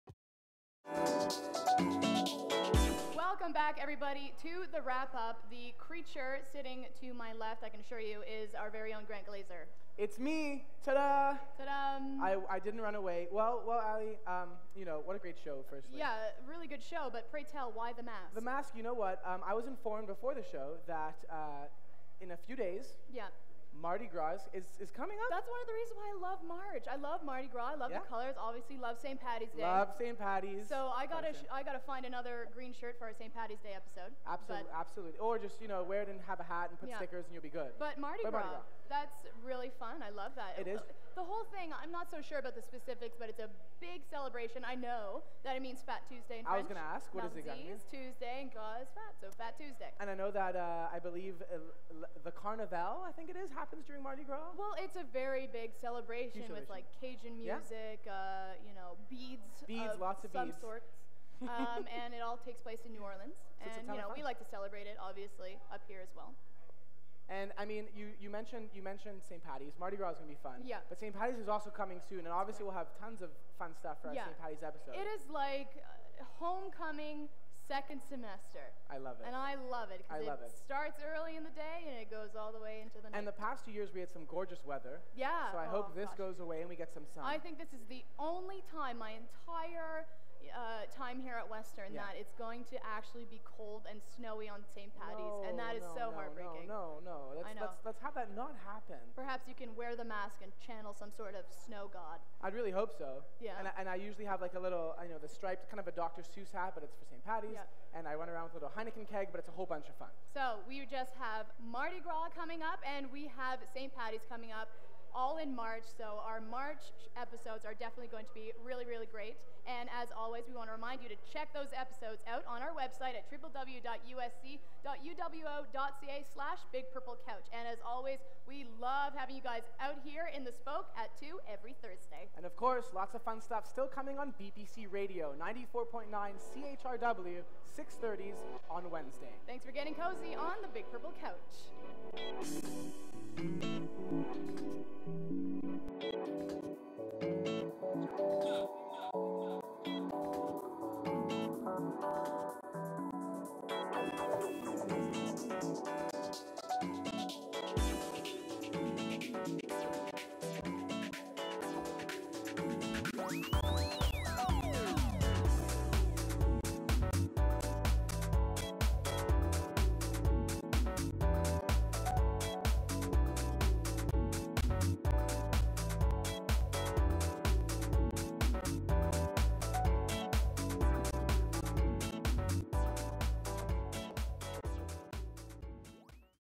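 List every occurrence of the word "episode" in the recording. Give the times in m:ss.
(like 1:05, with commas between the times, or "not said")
0:33, 1:14, 1:57, 2:01.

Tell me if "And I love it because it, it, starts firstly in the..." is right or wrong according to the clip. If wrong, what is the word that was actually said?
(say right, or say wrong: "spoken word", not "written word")
wrong: "early", not "firstly".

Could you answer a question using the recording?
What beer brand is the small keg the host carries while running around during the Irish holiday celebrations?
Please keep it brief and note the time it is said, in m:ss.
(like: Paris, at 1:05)
Heineken, at 1:48.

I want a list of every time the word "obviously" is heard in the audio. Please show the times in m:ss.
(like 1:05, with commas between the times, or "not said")
0:28, 1:04, 1:12.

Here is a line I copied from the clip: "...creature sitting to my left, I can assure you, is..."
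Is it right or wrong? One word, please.
right.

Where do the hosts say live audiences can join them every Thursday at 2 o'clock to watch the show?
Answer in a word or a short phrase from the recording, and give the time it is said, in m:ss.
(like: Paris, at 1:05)
The Spoke, at 2:10.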